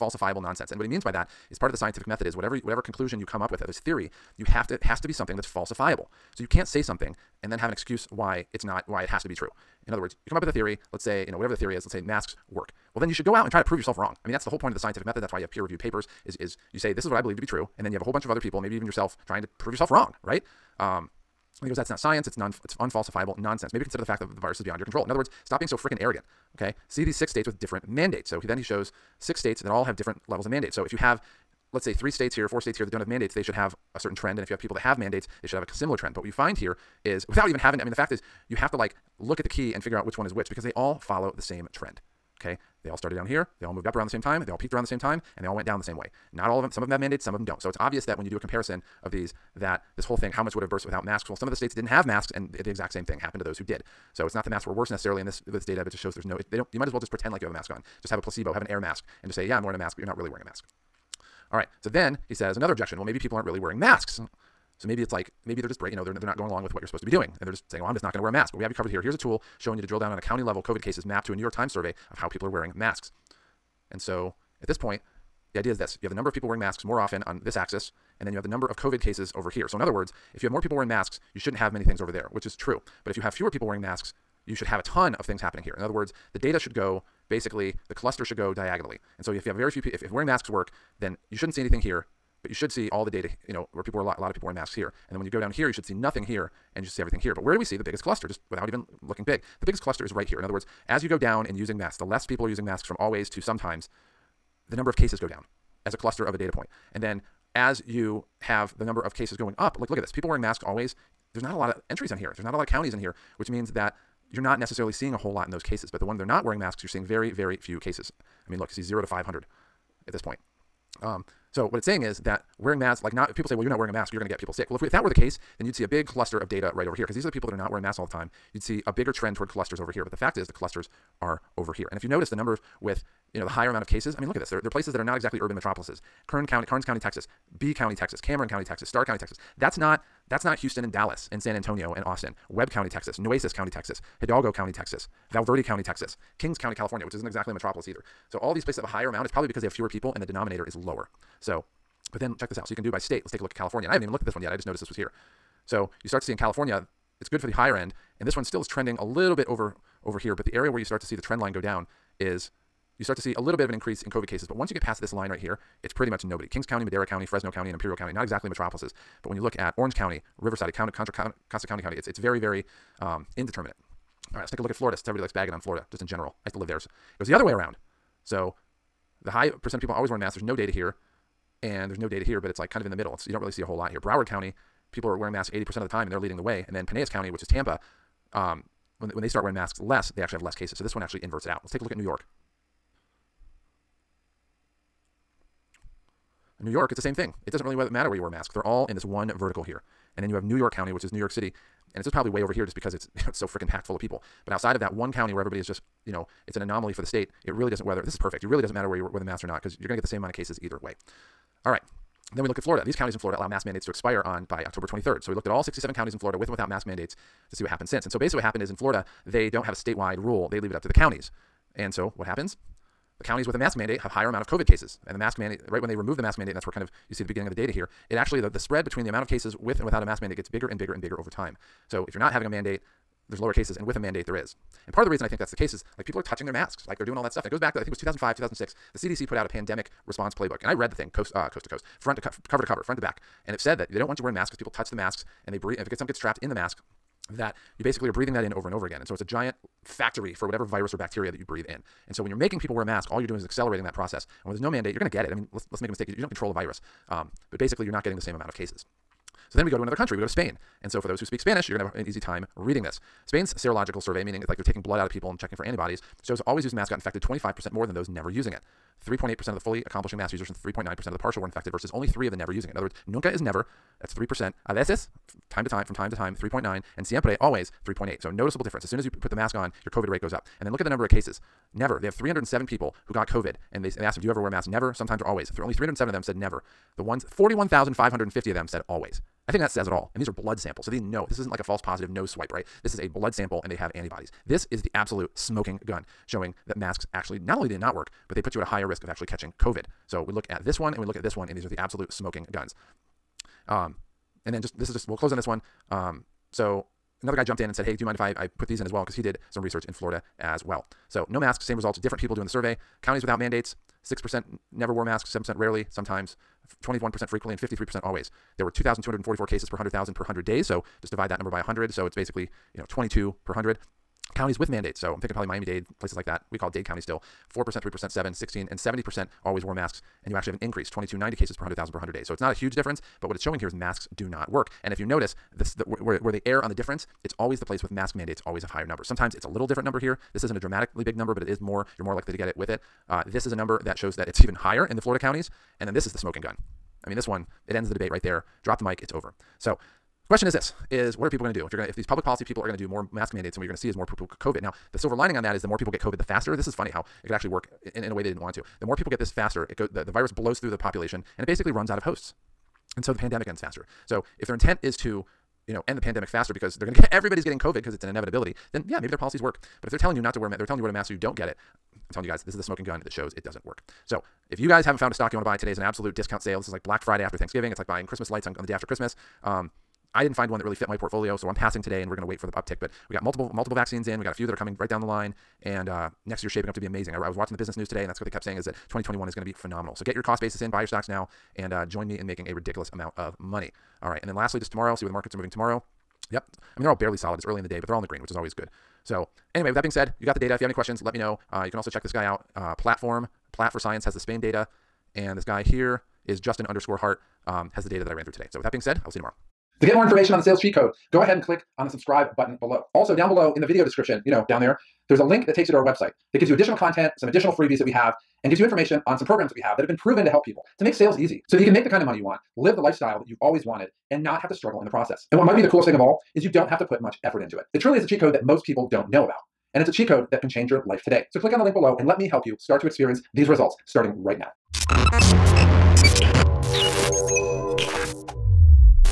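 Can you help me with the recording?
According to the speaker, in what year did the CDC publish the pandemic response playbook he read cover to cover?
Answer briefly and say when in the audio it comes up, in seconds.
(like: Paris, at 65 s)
2005, at 237 s.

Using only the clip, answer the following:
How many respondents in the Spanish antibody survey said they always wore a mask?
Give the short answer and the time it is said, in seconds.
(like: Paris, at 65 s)
41,550, at 287 s.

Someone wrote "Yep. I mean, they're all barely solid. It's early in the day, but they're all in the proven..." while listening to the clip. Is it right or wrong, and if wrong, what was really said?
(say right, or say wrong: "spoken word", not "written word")
wrong: "green", not "proven".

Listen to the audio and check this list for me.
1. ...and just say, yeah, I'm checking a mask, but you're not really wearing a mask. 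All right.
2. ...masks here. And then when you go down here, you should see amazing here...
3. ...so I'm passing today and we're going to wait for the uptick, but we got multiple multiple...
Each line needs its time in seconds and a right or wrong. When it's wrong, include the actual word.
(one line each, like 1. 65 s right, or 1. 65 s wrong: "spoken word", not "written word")
1. 59 s wrong: "wearing", not "checking"
2. 94 s wrong: "nothing", not "amazing"
3. 381 s right.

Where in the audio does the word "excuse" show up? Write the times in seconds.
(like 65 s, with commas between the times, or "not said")
7 s.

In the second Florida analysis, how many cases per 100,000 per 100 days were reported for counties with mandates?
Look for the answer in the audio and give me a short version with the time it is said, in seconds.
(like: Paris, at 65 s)
2290, at 330 s.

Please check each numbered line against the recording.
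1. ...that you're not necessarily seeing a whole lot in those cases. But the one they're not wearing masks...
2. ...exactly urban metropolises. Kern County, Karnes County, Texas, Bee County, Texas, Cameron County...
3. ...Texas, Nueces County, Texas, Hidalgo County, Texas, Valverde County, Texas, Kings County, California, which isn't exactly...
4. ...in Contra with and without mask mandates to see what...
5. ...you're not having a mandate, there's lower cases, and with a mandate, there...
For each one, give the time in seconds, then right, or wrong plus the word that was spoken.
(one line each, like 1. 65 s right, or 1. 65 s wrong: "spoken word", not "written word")
1. 113 s right
2. 135 s right
3. 142 s right
4. 216 s wrong: "Florida", not "Contra"
5. 232 s right.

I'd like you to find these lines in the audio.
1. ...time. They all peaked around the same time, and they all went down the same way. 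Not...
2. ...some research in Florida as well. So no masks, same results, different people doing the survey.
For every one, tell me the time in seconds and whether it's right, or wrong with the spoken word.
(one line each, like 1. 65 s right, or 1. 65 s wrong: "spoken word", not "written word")
1. 44 s right
2. 309 s right.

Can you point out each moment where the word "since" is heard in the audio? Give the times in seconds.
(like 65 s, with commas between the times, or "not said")
174 s, 217 s.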